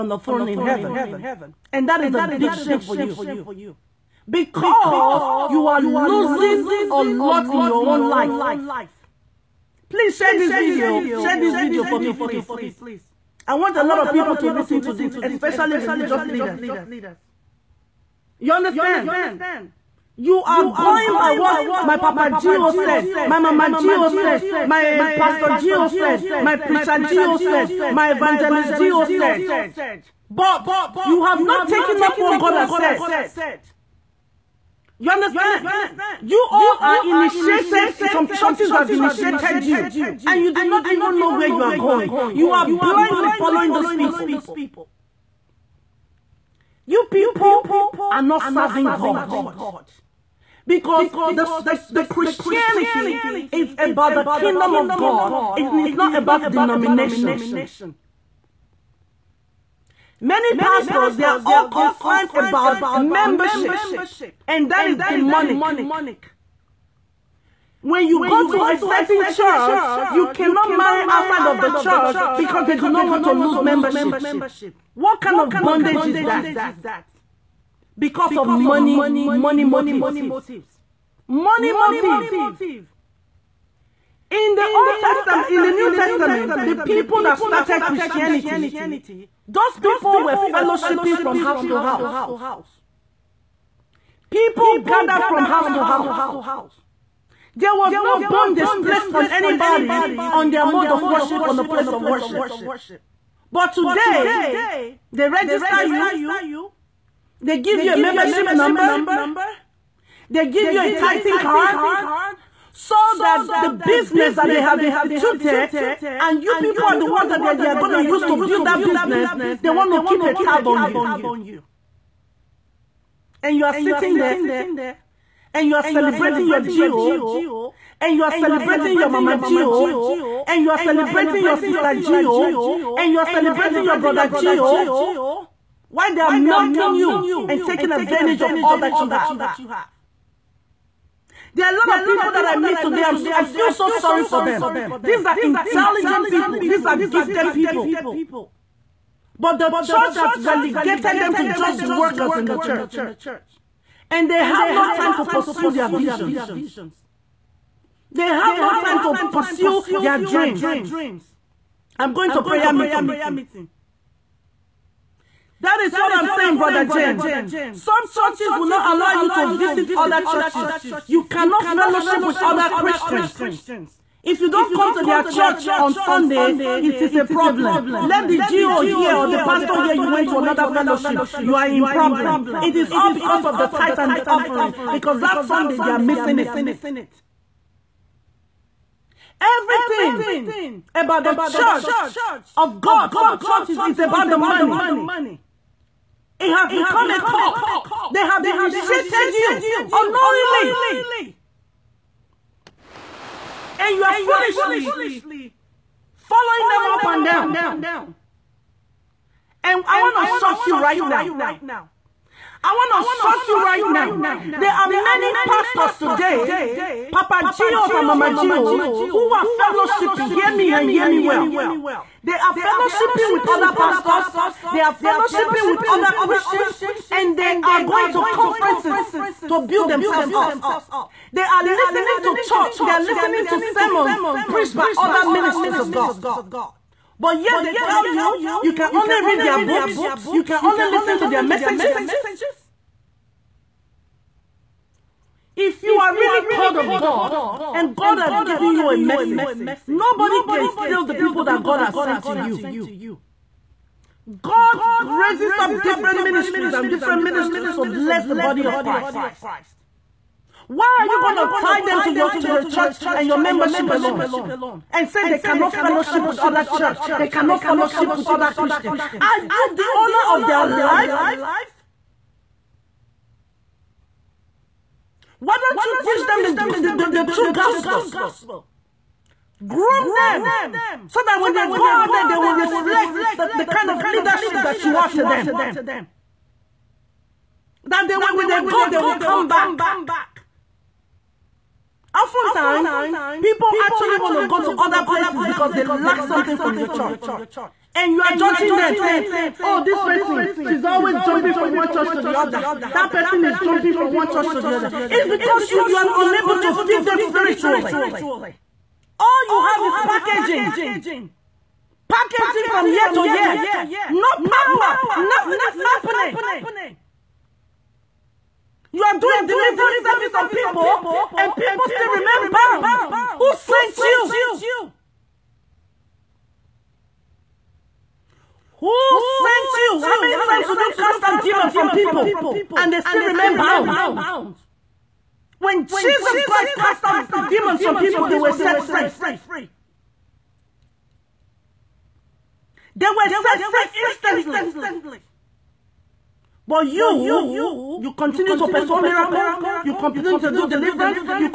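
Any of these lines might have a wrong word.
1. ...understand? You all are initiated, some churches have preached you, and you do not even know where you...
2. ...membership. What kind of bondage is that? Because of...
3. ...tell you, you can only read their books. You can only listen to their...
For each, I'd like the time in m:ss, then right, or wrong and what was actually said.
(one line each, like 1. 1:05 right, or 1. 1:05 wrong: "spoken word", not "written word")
1. 0:35 wrong: "initiated", not "preached"
2. 1:13 right
3. 3:57 right.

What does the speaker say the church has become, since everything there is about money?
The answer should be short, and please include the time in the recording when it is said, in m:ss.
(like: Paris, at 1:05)
a cult, at 3:17.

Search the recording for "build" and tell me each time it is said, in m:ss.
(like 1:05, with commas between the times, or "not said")
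1:58, 3:49.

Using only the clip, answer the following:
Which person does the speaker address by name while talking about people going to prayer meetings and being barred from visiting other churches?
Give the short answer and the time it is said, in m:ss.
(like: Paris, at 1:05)
Brother James, at 2:46.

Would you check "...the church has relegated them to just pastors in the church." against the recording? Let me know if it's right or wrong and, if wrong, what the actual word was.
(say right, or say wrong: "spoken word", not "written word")
wrong: "workers", not "pastors".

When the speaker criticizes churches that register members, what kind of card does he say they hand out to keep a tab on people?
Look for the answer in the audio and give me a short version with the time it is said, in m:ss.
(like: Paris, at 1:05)
titan card, at 1:50.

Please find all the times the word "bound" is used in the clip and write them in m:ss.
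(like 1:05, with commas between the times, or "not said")
5:22, 5:33.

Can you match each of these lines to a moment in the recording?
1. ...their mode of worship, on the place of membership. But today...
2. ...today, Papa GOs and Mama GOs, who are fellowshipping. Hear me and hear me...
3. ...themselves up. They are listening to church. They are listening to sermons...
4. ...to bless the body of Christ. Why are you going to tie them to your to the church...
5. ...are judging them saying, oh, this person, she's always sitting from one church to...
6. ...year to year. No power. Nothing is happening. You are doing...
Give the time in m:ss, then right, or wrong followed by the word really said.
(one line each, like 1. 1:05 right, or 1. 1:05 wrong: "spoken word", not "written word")
1. 1:40 wrong: "worship", not "membership"
2. 3:35 right
3. 3:49 right
4. 4:17 right
5. 4:58 wrong: "jumping", not "sitting"
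6. 5:12 right.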